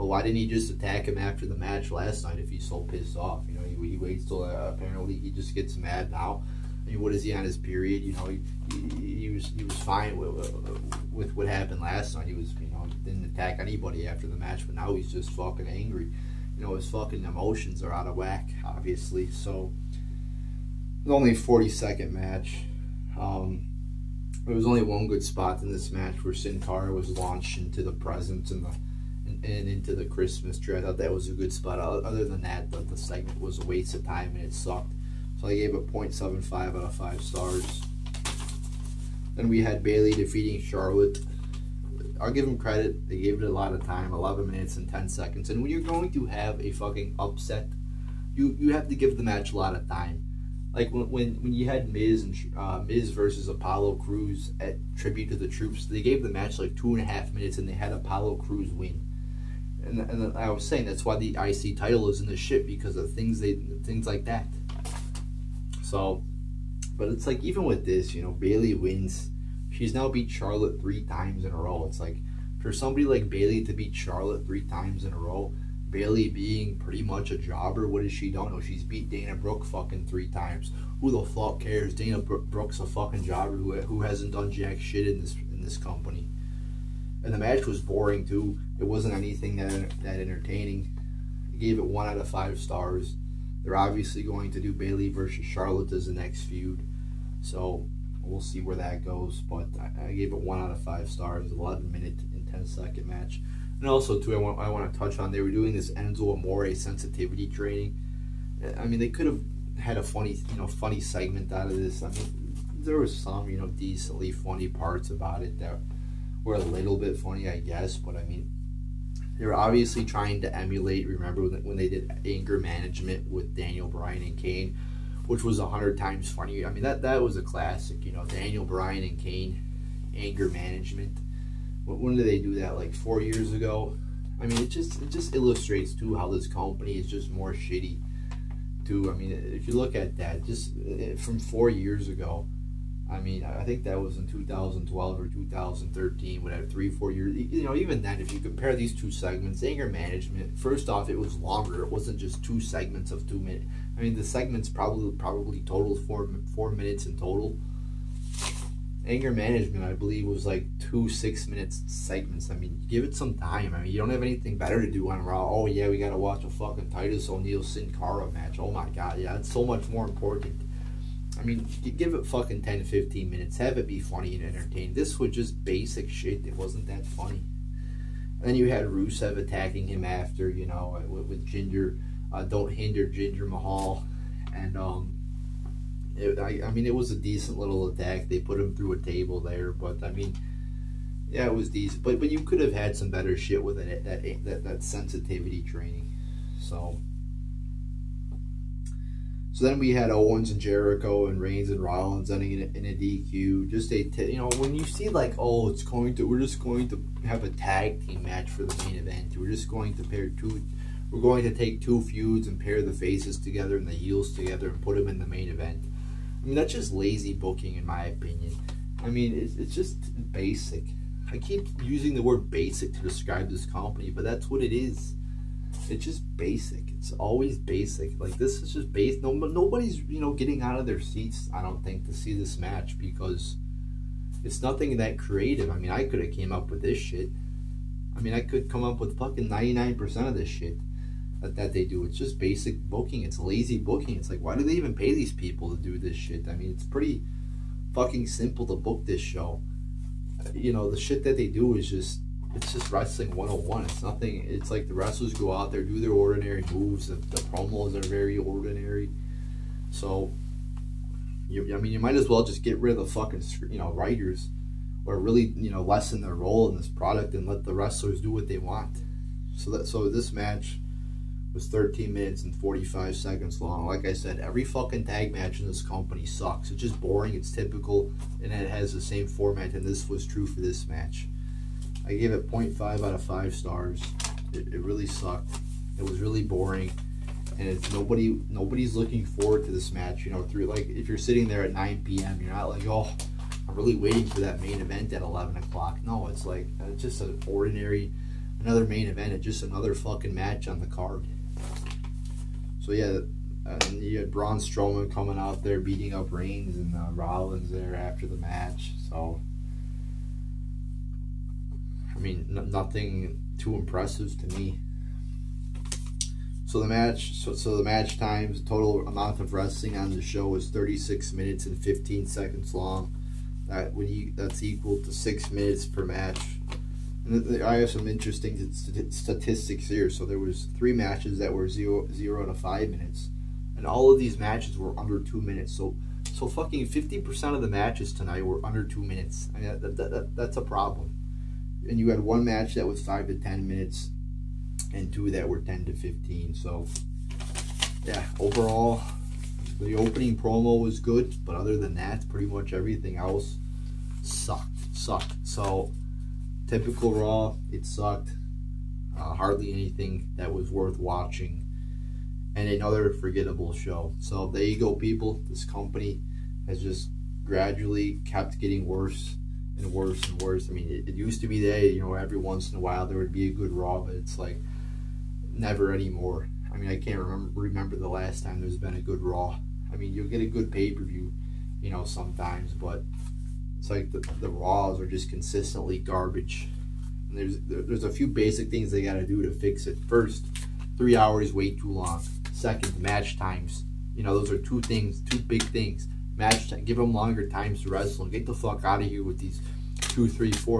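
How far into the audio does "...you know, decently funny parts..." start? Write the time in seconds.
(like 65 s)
113 s.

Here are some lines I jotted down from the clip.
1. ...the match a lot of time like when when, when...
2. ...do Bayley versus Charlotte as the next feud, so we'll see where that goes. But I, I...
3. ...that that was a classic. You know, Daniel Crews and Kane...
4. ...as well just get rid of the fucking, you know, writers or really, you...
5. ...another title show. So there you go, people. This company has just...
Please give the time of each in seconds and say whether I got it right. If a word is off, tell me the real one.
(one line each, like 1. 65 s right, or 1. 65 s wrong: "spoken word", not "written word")
1. 49 s right
2. 94 s right
3. 126 s wrong: "Bryan", not "Crews"
4. 262 s right
5. 362 s wrong: "forgettable", not "title".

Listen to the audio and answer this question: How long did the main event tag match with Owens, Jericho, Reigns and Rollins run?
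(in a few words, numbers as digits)
13 minutes and 45 seconds.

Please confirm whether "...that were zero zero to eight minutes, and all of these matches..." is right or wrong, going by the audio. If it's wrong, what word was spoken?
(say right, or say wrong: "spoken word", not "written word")
wrong: "five", not "eight".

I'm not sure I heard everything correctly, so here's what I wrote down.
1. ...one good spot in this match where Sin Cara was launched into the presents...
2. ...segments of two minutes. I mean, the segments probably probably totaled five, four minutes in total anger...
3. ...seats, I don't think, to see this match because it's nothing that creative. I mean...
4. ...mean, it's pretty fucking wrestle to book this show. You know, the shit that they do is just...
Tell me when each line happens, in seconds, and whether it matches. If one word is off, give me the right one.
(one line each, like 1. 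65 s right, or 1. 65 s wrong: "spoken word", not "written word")
1. 24 s right
2. 152 s wrong: "four", not "five"
3. 231 s right
4. 246 s wrong: "simple", not "wrestle".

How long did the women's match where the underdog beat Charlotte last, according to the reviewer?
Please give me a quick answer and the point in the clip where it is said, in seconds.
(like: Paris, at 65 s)
11 minutes and 10 seconds, at 44 s.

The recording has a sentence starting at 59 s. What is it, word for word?
And and I was saying that's why the IC title is in the shit because of things they things like that.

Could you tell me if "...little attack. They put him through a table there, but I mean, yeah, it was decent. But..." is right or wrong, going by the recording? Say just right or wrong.
right.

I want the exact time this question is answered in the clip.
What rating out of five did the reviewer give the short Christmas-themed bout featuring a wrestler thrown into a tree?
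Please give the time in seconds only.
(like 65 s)
35 s.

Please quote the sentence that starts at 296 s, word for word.
No, it's like, it's uh, just an ordinary, another main event.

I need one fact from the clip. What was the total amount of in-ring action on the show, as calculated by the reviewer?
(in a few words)
36 minutes and 15 seconds.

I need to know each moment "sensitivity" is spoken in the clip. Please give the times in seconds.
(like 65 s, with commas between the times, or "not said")
106 s, 194 s.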